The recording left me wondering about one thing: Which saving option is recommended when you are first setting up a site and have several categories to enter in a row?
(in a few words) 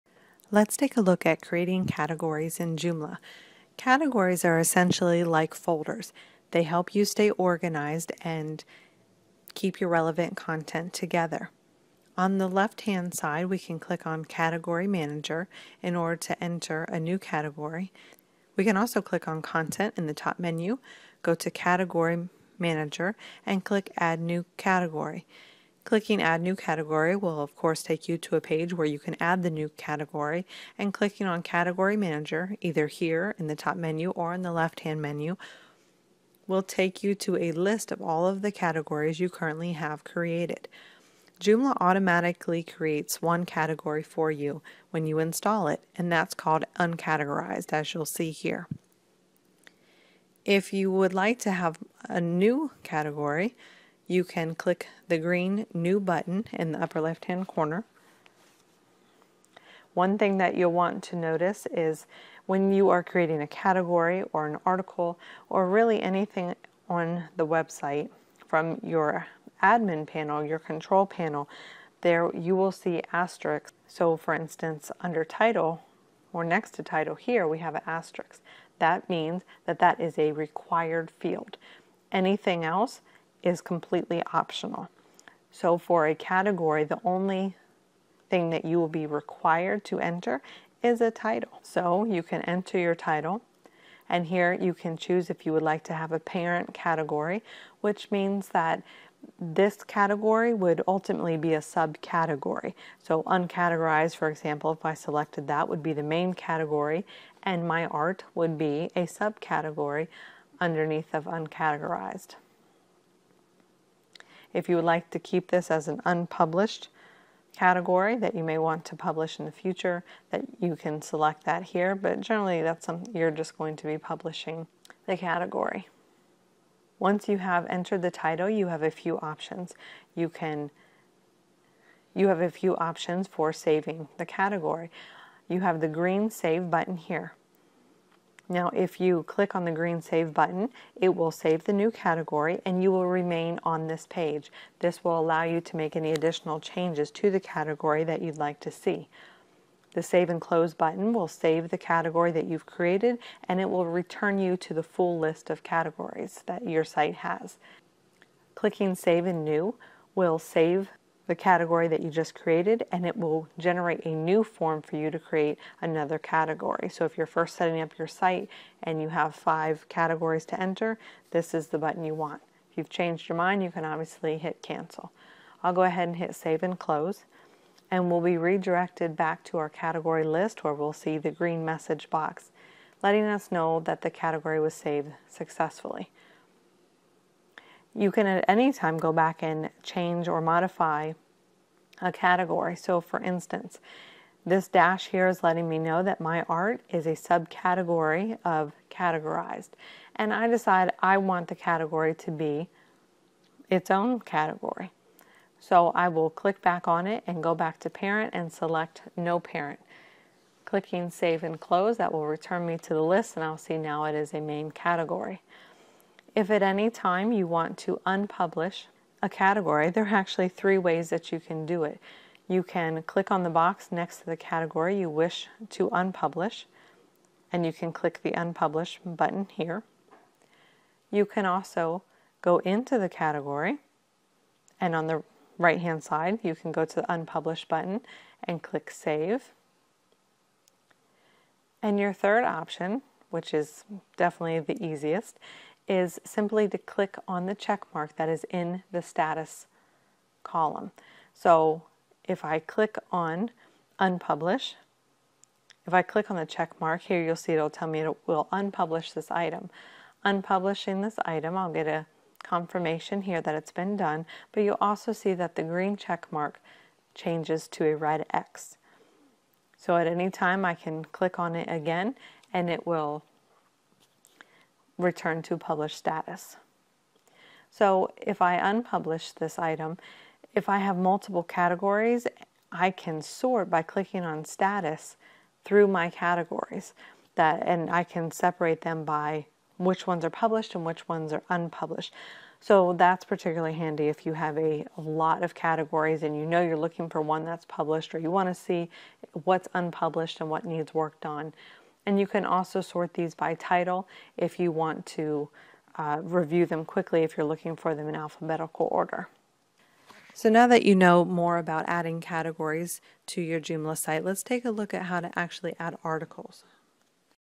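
Save and New.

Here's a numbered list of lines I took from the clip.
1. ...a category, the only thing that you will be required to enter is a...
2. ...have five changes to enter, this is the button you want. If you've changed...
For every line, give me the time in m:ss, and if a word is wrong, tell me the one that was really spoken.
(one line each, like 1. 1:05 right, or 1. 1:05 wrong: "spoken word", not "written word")
1. 1:26 right
2. 2:49 wrong: "categories", not "changes".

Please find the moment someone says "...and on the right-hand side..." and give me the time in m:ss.
3:54.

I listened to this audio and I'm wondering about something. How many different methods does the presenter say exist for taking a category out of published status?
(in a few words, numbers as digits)
3.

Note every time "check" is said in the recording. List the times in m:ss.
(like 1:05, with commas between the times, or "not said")
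4:07, 4:16, 4:25.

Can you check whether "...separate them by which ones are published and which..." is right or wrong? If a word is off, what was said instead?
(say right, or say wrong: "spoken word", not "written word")
right.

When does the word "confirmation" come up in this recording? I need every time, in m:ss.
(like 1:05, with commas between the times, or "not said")
4:22.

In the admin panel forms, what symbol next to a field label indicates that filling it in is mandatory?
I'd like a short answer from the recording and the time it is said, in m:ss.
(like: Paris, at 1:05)
Asterisks, at 1:13.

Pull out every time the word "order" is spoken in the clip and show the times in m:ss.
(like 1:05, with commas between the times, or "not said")
0:15, 5:08.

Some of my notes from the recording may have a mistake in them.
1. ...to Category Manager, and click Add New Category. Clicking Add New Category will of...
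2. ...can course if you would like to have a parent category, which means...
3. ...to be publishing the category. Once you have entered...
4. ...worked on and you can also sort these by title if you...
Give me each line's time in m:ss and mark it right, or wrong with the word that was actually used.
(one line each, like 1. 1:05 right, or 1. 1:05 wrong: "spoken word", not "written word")
1. 0:21 right
2. 1:34 wrong: "choose", not "course"
3. 2:03 right
4. 5:00 right.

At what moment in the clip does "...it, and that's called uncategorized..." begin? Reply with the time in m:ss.
0:45.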